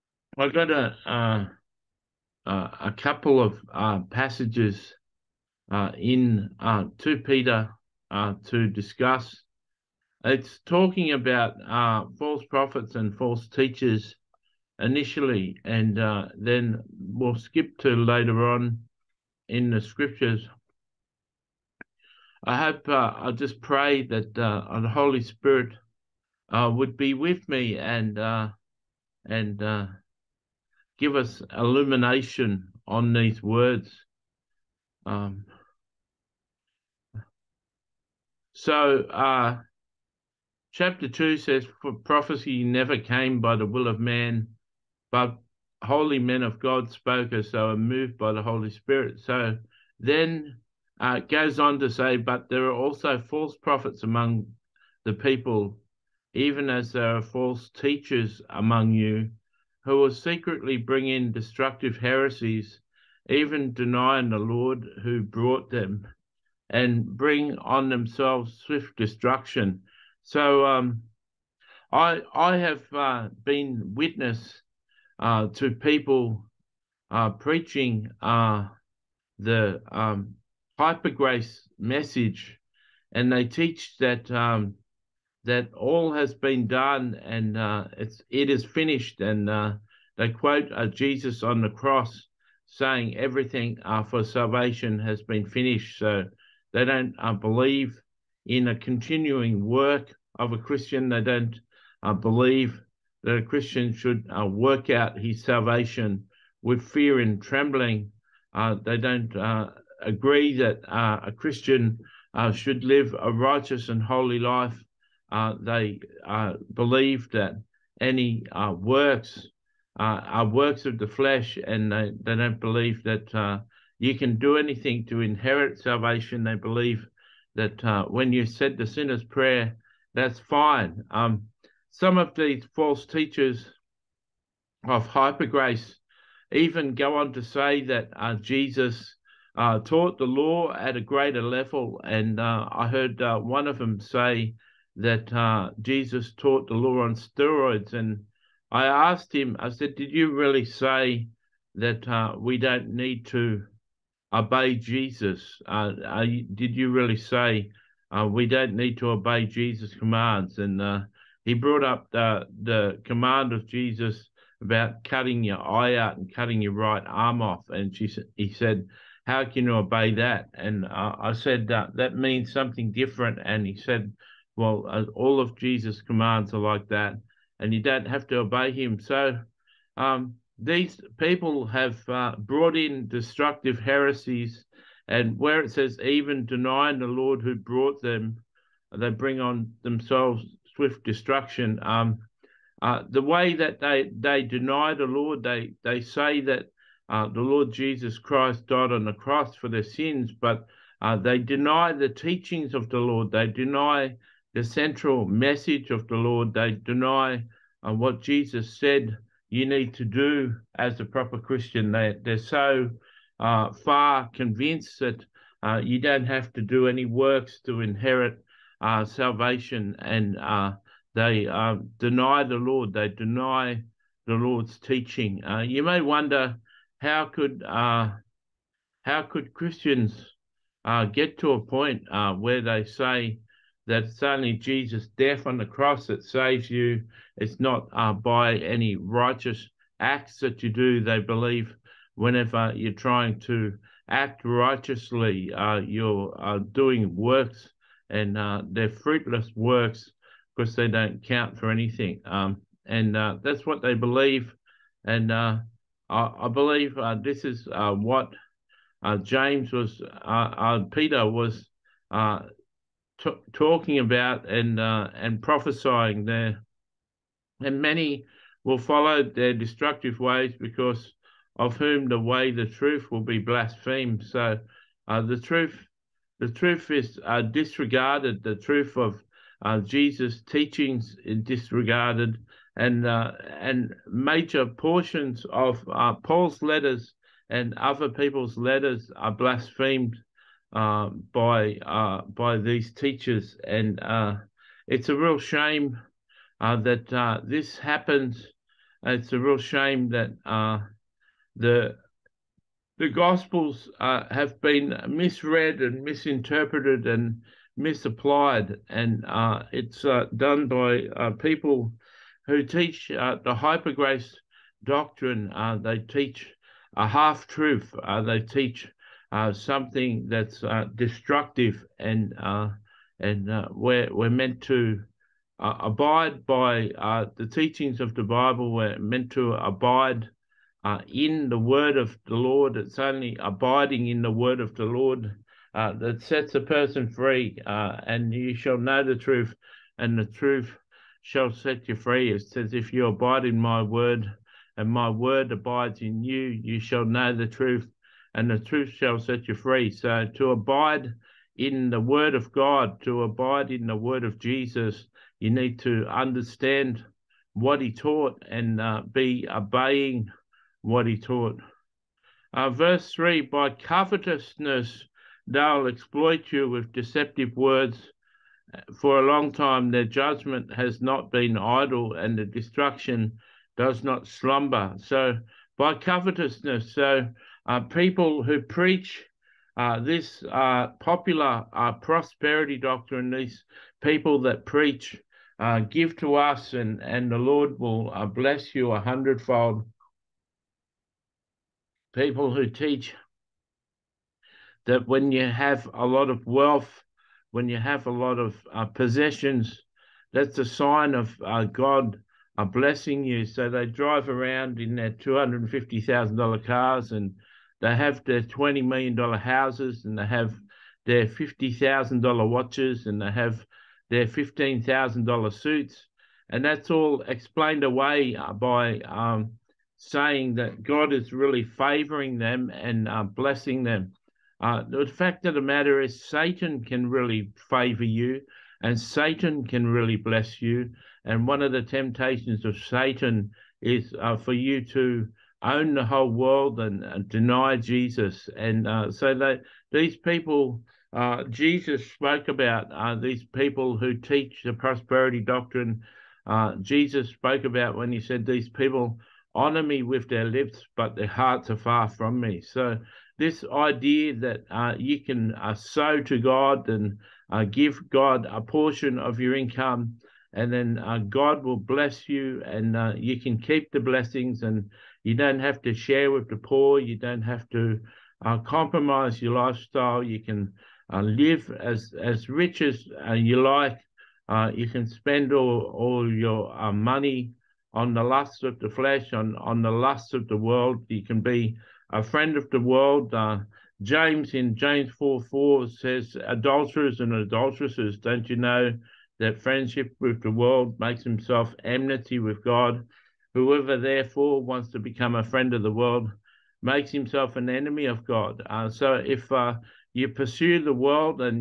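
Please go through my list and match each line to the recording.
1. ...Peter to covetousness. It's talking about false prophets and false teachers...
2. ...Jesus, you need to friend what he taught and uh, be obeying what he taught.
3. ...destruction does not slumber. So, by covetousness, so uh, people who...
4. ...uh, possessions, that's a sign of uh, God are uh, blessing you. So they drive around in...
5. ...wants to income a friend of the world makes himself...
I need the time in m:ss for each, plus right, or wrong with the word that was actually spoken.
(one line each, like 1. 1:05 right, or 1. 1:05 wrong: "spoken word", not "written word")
1. 0:07 wrong: "discuss", not "covetousness"
2. 5:54 wrong: "understand", not "friend"
3. 6:12 right
4. 6:38 right
5. 8:14 wrong: "become", not "income".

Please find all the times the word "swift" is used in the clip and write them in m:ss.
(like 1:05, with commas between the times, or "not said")
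1:08, 3:10.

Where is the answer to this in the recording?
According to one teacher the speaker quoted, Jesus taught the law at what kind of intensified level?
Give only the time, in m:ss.
2:27.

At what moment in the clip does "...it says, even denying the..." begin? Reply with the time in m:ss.
3:05.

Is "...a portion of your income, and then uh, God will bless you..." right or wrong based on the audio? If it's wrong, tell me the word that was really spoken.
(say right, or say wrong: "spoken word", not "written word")
right.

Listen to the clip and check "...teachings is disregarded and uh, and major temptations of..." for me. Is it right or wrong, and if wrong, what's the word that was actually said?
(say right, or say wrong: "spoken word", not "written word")
wrong: "portions", not "temptations".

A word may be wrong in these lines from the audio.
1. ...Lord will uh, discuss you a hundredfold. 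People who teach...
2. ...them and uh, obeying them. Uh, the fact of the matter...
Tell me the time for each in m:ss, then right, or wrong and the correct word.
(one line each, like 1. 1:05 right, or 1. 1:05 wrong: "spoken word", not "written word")
1. 6:27 wrong: "bless", not "discuss"
2. 7:02 wrong: "blessing", not "obeying".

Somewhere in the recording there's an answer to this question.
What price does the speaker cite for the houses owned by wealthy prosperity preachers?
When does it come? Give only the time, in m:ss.
6:48.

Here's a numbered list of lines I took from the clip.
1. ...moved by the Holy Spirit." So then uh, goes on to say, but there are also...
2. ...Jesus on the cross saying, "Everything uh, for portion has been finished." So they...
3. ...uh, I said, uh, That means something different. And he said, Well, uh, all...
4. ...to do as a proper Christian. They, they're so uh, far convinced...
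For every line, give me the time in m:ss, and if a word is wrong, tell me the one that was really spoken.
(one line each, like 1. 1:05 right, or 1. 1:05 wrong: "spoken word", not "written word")
1. 0:47 right
2. 1:30 wrong: "salvation", not "portion"
3. 2:50 right
4. 3:29 right.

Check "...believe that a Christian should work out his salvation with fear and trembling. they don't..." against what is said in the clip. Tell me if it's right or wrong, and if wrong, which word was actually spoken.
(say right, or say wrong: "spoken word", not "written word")
right.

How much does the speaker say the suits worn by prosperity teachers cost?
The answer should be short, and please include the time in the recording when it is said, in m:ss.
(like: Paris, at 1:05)
$15,000, at 6:54.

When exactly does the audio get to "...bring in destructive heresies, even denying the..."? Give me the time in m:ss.
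1:00.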